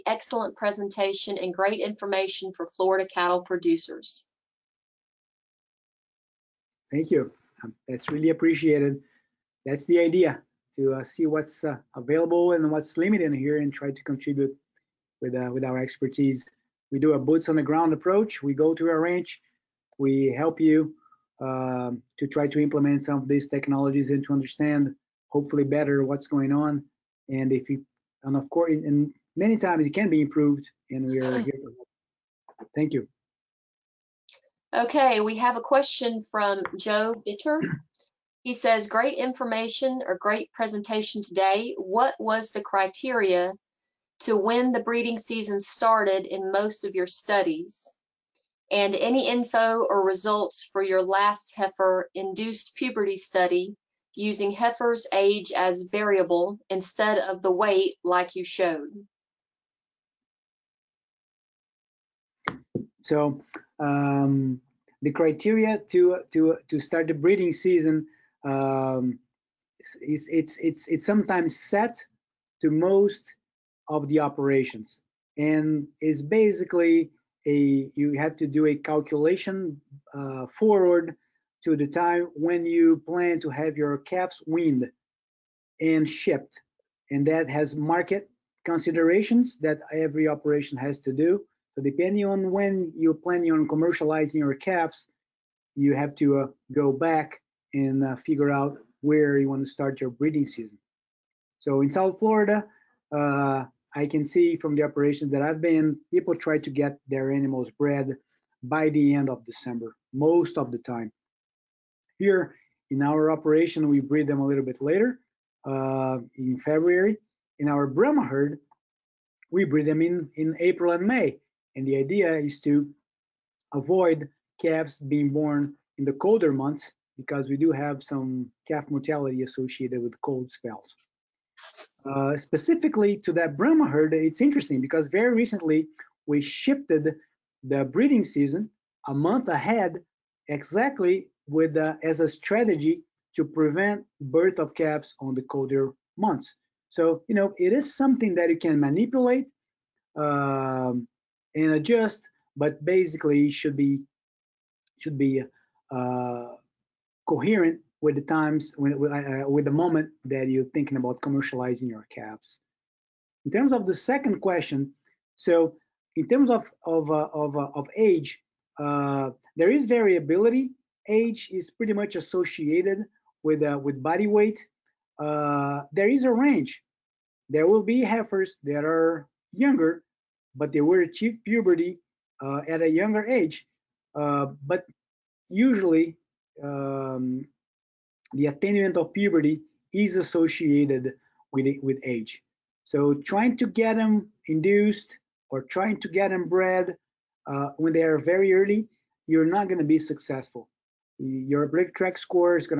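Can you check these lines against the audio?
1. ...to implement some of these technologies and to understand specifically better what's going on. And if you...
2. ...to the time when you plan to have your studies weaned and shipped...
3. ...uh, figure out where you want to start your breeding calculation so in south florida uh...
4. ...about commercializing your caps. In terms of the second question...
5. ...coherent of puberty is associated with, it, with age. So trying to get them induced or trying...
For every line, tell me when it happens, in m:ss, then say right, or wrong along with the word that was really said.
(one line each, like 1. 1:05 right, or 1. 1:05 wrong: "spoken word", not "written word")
1. 0:22 wrong: "hopefully", not "specifically"
2. 1:21 wrong: "calves", not "studies"
3. 1:38 wrong: "season", not "calculation"
4. 2:40 right
5. 3:08 wrong: "attainment", not "coherent".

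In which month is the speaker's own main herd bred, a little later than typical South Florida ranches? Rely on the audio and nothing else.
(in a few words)
February.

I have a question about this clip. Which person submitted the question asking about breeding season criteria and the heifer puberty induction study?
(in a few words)
Joe Bitter.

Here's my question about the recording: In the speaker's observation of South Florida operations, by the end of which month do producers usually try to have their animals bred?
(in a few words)
December.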